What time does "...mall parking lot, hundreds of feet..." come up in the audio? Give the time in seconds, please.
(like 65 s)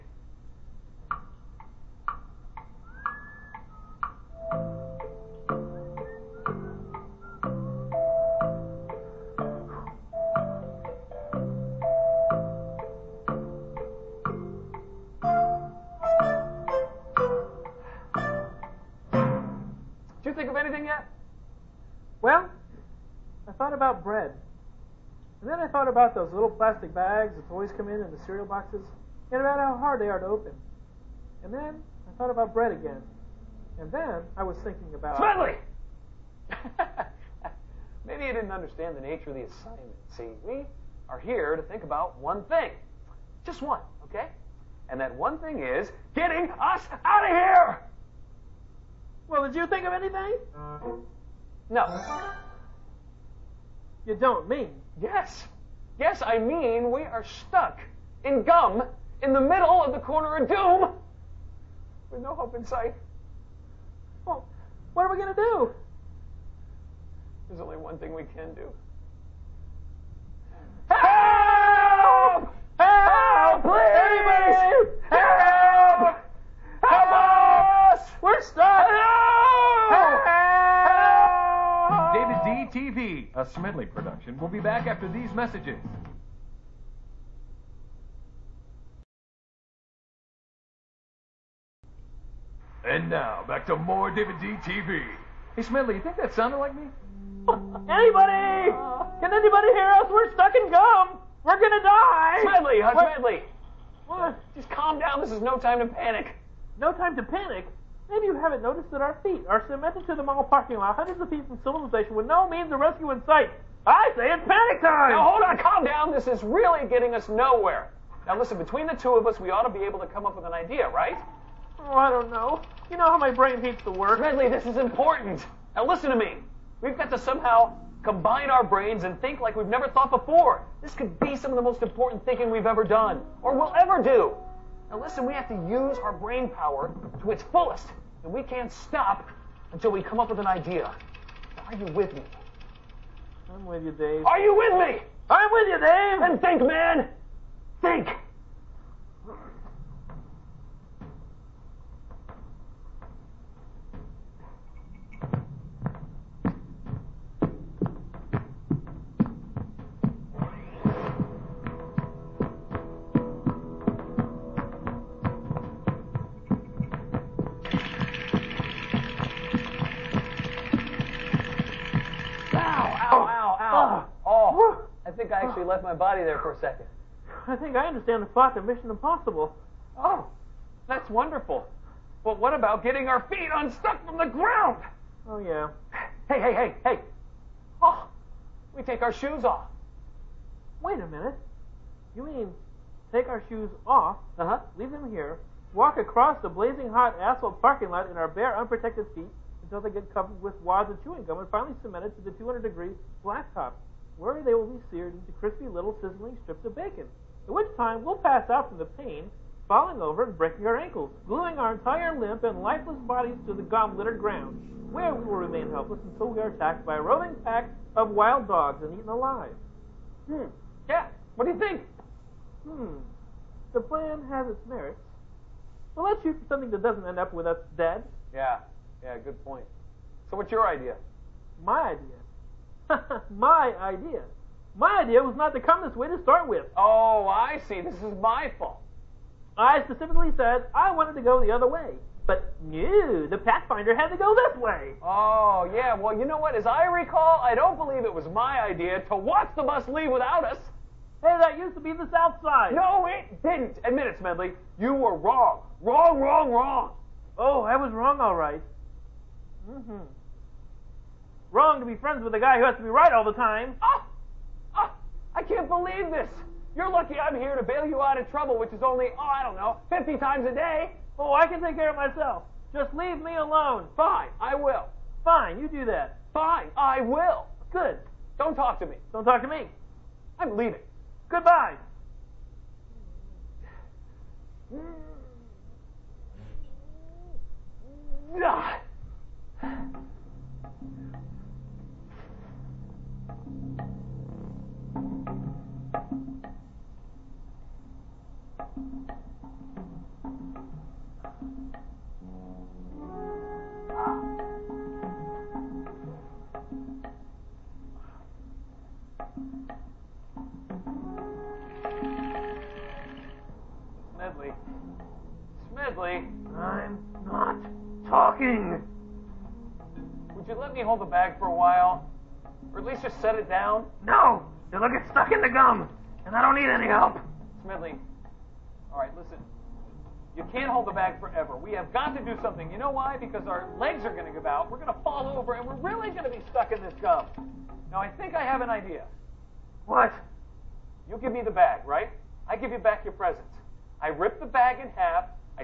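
110 s.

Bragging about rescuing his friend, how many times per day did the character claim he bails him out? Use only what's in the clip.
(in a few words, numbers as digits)
50.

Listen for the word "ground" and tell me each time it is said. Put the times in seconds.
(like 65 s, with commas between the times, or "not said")
184 s, 214 s.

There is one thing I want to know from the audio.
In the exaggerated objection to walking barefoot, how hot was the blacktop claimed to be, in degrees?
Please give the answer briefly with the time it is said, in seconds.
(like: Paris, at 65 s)
200, at 202 s.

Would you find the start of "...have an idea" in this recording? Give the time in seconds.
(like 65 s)
338 s.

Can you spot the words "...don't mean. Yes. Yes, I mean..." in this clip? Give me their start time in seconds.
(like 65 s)
54 s.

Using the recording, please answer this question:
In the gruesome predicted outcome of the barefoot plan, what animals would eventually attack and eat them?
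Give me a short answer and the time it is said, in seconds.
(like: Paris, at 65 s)
wild dogs, at 218 s.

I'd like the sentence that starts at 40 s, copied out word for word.
See, we are here to think about one thing.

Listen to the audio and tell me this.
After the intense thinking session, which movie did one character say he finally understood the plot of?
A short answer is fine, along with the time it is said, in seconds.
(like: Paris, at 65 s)
Mission Impossible, at 178 s.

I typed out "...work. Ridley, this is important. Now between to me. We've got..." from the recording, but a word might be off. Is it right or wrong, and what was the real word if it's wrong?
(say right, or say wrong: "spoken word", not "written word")
wrong: "listen", not "between".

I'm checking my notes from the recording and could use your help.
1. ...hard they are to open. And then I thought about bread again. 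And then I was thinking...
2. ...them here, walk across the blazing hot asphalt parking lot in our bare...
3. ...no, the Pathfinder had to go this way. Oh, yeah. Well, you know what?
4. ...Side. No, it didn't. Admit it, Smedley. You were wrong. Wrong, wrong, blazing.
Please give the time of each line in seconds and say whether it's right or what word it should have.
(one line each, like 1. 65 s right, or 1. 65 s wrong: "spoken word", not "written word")
1. 29 s right
2. 194 s right
3. 242 s right
4. 252 s wrong: "wrong", not "blazing".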